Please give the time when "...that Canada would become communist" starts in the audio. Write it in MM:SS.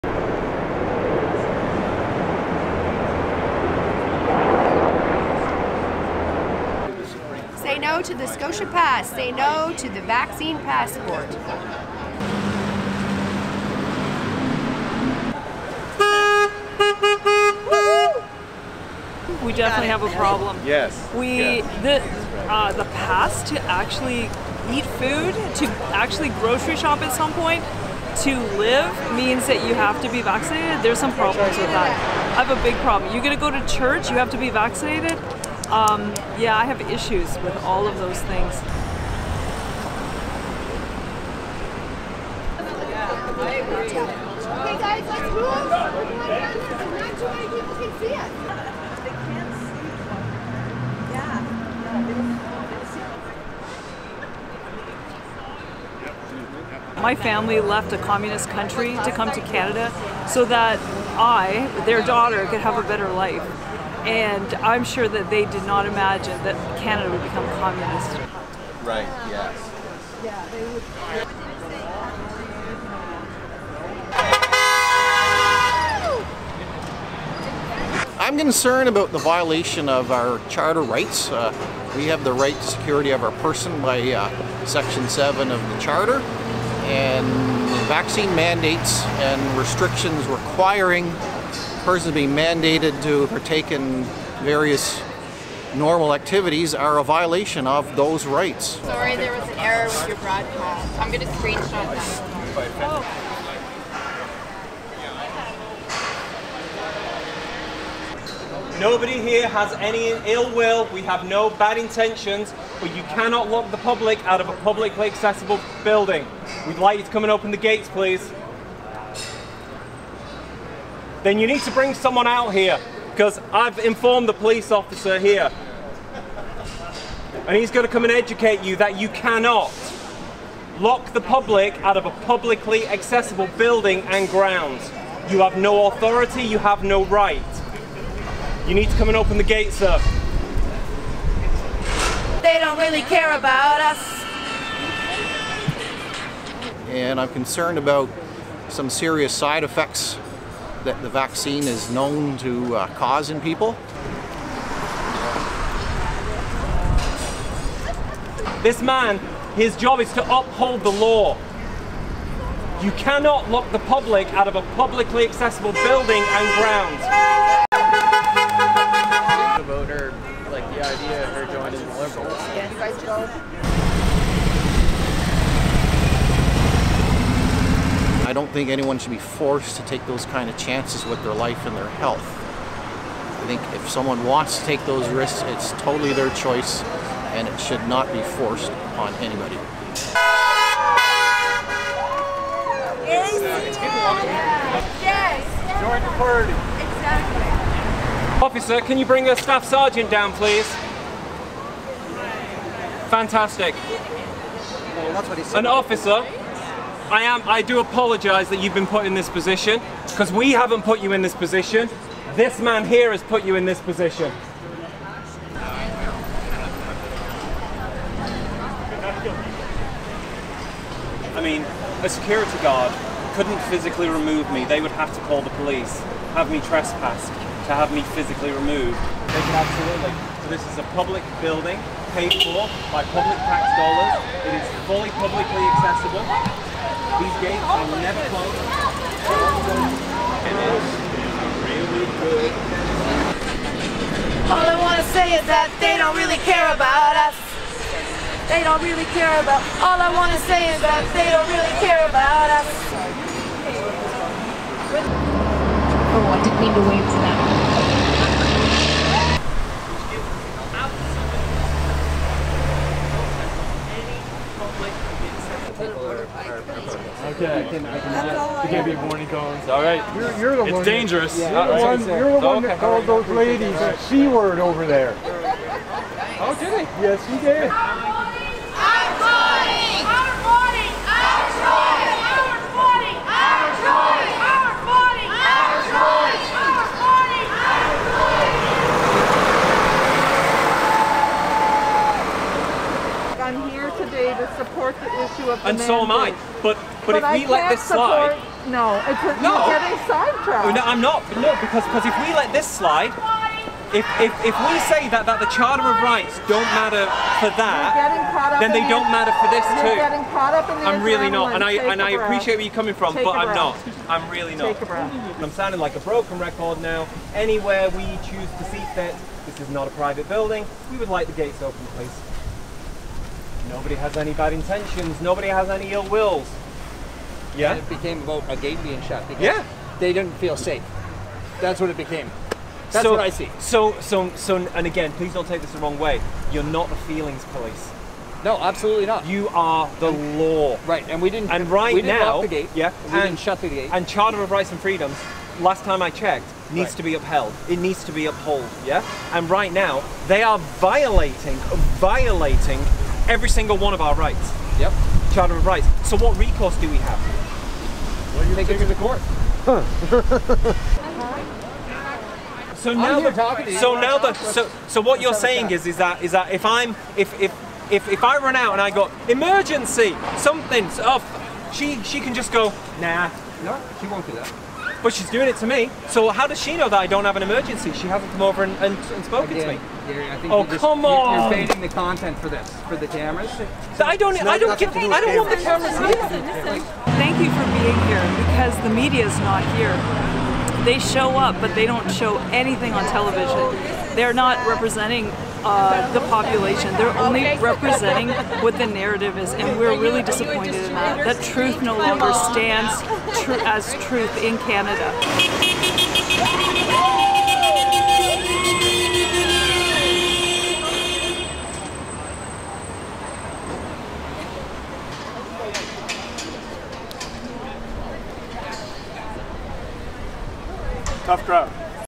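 01:06.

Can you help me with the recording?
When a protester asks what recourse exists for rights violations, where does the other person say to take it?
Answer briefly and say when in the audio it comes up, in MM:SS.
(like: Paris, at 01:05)
the court, at 05:58.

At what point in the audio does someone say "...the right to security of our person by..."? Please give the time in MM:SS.
01:22.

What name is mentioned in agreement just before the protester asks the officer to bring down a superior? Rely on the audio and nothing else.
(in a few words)
Jordan Purdy.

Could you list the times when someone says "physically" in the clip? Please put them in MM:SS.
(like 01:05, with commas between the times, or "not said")
03:43, 03:48.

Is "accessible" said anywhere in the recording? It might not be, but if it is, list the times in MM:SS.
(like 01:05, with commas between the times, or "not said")
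01:55, 02:12, 02:45, 03:55.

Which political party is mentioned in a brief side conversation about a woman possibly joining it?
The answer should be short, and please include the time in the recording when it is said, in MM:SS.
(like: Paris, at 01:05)
the Liberals, at 02:52.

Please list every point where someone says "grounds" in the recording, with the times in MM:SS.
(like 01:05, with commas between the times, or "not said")
02:14, 02:46.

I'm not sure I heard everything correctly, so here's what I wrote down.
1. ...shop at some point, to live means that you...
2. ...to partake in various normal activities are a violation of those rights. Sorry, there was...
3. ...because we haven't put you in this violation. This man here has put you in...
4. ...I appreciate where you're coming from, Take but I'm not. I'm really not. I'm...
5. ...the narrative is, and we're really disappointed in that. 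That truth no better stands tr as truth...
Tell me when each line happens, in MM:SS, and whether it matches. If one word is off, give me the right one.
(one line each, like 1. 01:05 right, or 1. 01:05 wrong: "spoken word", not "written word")
1. 00:26 right
2. 01:33 right
3. 03:30 wrong: "position", not "violation"
4. 05:12 right
5. 06:38 wrong: "longer", not "better".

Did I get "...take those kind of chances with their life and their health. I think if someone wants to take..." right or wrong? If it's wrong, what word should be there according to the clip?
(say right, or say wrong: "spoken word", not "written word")
right.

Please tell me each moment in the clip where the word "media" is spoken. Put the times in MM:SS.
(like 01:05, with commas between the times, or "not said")
06:28.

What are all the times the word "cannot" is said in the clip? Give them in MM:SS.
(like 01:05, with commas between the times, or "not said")
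01:53, 02:09, 02:42.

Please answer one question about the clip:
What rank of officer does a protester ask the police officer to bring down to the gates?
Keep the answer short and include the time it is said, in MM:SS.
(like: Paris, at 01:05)
staff sergeant, at 03:19.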